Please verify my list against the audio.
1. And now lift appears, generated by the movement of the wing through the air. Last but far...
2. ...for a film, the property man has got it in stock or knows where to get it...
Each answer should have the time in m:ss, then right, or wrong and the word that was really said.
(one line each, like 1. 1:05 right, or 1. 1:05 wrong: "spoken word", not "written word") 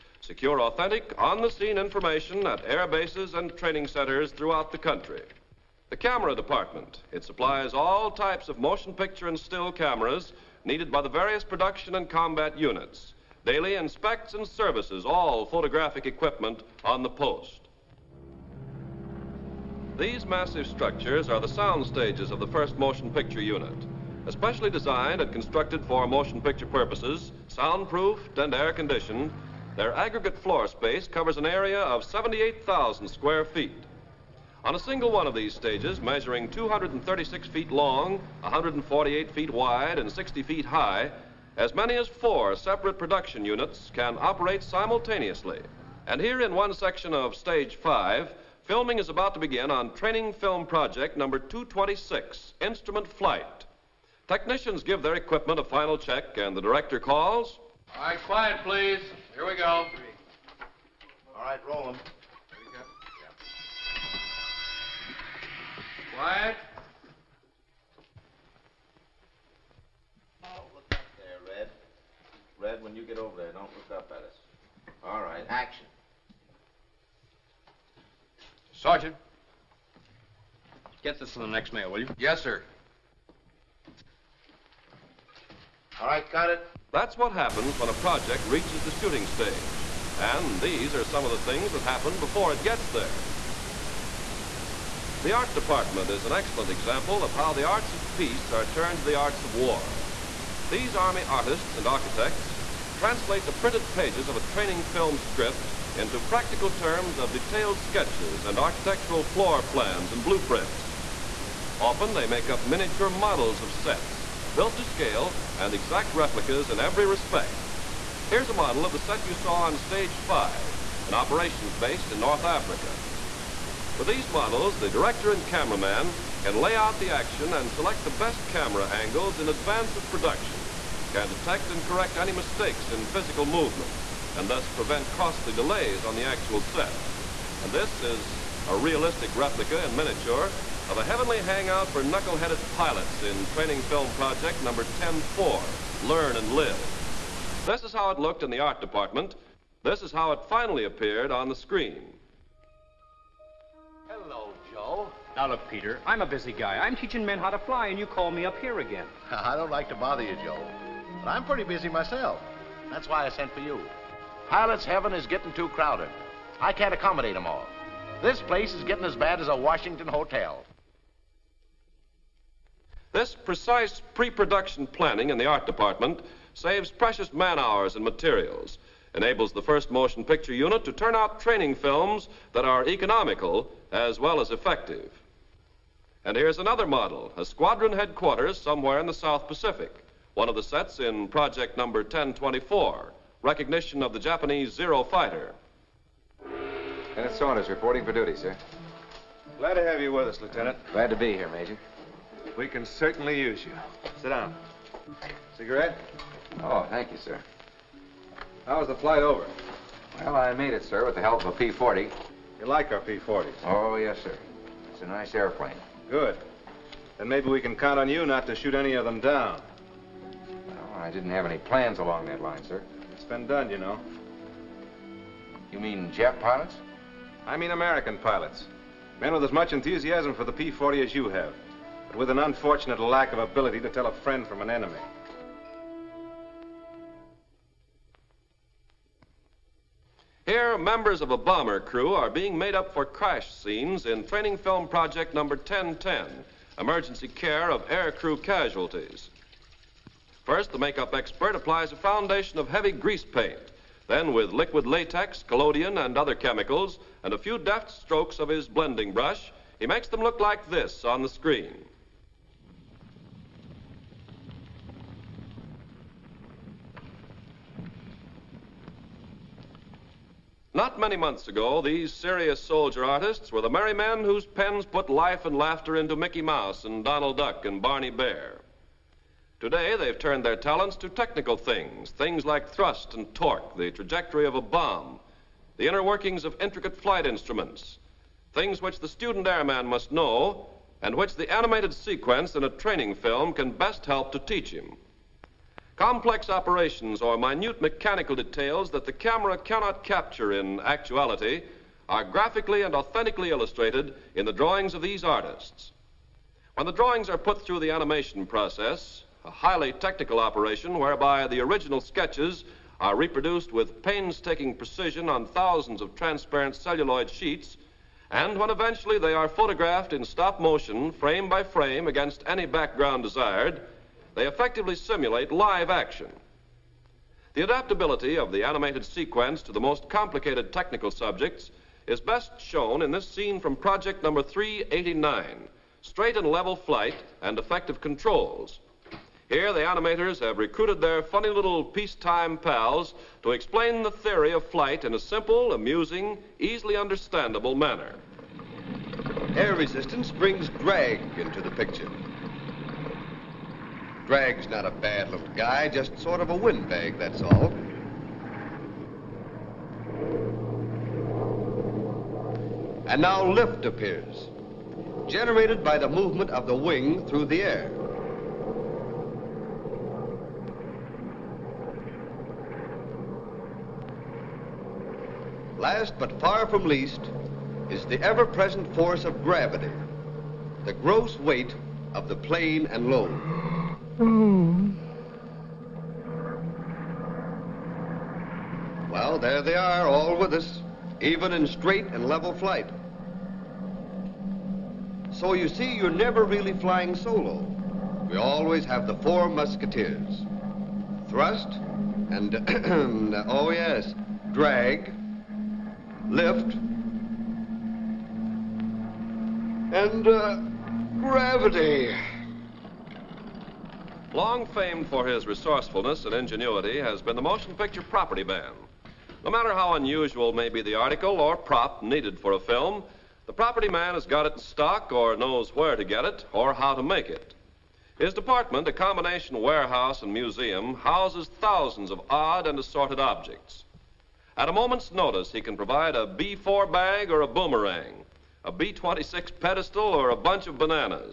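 1. 6:03 right
2. 7:02 right.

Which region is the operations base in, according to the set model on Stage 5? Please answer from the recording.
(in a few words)
North Africa.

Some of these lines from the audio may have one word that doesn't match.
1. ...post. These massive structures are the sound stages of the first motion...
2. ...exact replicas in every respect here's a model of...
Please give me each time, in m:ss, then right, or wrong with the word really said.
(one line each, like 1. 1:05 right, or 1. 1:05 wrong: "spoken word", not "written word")
1. 0:17 right
2. 1:55 right.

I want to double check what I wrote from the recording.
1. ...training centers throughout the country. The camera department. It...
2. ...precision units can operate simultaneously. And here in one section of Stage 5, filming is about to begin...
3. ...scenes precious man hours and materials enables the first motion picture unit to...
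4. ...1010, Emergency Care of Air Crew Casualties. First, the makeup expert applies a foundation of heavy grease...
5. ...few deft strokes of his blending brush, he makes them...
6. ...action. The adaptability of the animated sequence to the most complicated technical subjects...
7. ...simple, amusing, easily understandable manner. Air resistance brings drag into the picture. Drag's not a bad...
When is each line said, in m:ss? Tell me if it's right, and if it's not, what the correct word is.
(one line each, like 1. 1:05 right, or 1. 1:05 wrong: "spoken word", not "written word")
1. 0:03 right
2. 0:42 wrong: "production", not "precision"
3. 2:56 wrong: "saves", not "scenes"
4. 4:05 right
5. 4:17 right
6. 5:25 right
7. 5:45 right.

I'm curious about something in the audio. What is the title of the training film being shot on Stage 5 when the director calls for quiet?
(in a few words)
Instrument Flight.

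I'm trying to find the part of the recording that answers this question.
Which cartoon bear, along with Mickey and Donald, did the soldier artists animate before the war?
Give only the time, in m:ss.
4:37.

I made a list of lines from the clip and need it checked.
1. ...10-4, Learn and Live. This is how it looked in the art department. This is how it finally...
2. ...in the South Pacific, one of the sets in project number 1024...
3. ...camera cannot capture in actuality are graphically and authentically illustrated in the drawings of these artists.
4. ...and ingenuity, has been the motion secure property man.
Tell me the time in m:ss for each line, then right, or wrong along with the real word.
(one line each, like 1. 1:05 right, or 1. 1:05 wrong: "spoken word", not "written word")
1. 2:24 right
2. 3:08 right
3. 4:59 right
4. 6:56 wrong: "picture", not "secure".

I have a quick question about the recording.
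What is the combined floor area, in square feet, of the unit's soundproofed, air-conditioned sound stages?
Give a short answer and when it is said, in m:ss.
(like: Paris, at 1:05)
78,000, at 0:32.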